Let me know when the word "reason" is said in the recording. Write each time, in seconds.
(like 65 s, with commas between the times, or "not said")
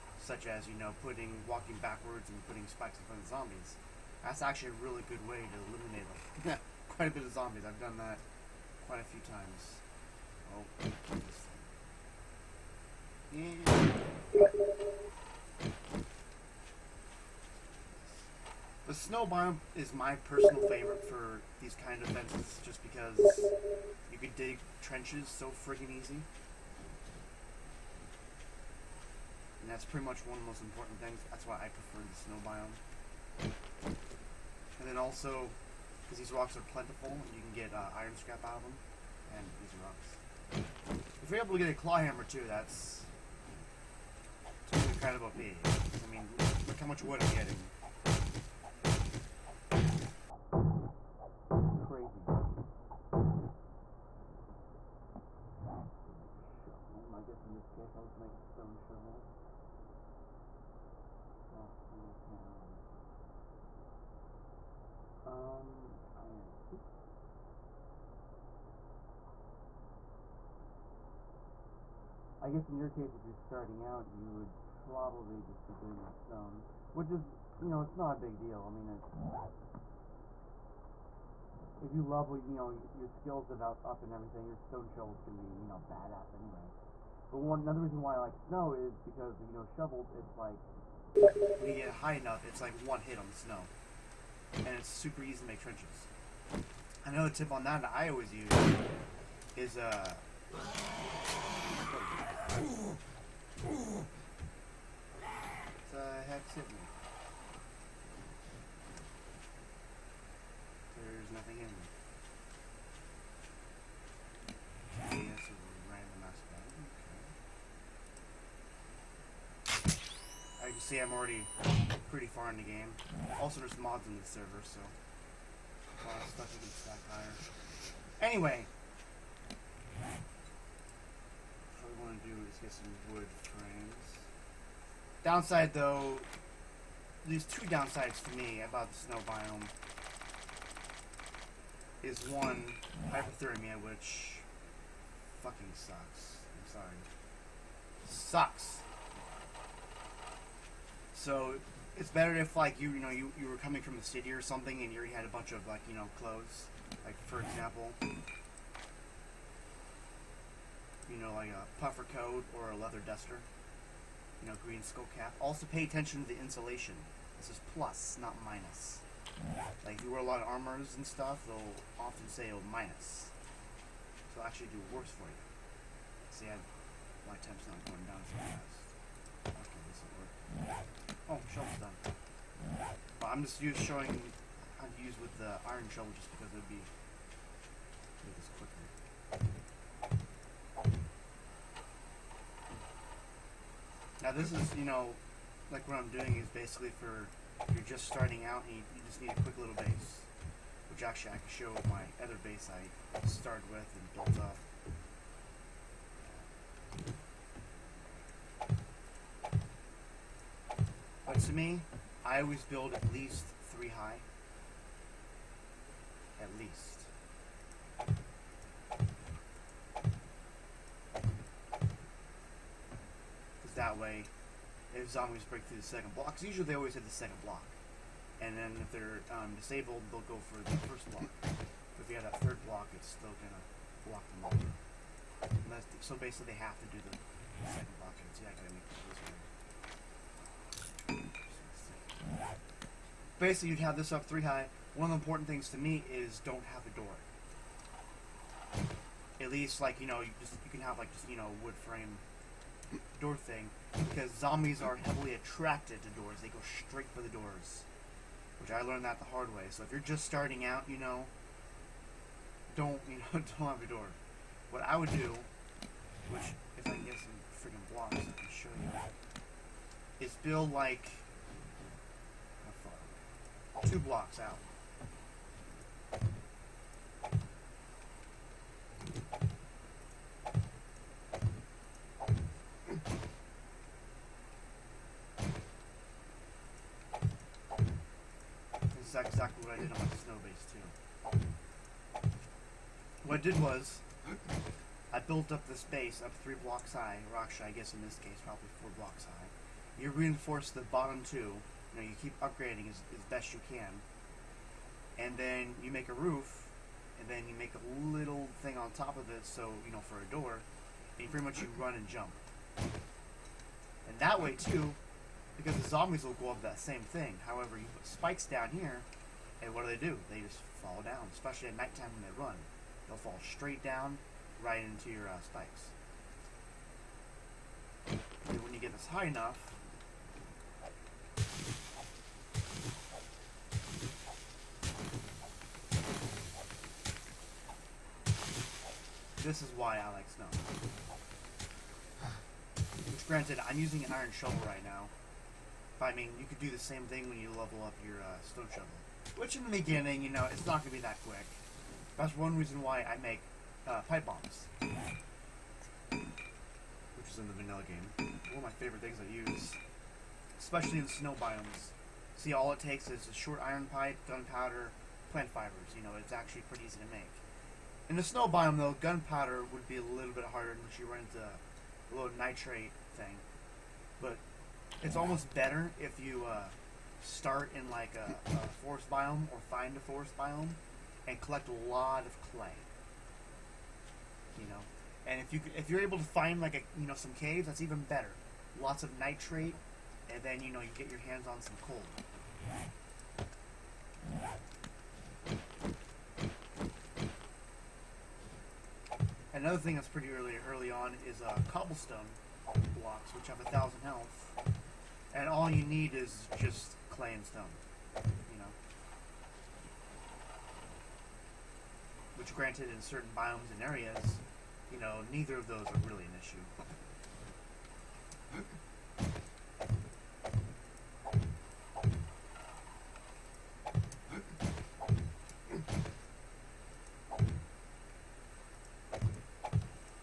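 87 s, 352 s.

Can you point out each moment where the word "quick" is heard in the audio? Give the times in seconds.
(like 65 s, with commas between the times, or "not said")
199 s, 351 s.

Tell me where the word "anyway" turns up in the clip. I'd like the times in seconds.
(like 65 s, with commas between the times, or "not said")
86 s, 128 s.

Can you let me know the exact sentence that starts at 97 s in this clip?
Another tip on that that I always use is uh so I have sent me.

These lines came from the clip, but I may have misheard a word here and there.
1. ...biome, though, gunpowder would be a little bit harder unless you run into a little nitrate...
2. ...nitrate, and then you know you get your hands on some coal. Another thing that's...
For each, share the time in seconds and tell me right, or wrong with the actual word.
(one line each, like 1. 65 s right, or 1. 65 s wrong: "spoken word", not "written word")
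1. 368 s right
2. 389 s right.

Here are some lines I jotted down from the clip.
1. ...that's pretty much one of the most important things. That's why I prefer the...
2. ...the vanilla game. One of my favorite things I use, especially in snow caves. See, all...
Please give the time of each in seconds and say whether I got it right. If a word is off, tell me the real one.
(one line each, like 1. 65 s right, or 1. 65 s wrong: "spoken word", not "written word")
1. 29 s right
2. 357 s wrong: "biomes", not "caves".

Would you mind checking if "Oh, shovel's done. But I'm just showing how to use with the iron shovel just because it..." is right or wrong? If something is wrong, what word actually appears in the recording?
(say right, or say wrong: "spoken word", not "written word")
right.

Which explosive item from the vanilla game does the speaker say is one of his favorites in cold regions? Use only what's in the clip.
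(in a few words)
pipe bombs.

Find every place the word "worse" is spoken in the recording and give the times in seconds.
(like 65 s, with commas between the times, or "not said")
174 s.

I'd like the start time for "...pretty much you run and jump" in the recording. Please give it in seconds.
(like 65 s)
311 s.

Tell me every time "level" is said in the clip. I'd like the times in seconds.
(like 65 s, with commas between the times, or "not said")
82 s, 347 s.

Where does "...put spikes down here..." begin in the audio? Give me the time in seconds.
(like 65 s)
317 s.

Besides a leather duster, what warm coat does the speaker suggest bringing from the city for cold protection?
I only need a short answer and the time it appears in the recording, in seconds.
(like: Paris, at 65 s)
puffer coat, at 161 s.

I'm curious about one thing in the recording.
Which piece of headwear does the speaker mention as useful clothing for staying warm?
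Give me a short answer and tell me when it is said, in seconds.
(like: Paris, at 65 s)
green skull cap, at 164 s.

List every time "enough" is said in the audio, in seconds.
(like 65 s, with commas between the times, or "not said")
92 s, 329 s.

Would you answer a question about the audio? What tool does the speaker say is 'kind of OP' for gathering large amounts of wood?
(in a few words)
claw hammer.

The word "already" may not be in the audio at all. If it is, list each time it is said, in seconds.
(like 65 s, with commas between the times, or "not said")
121 s, 154 s.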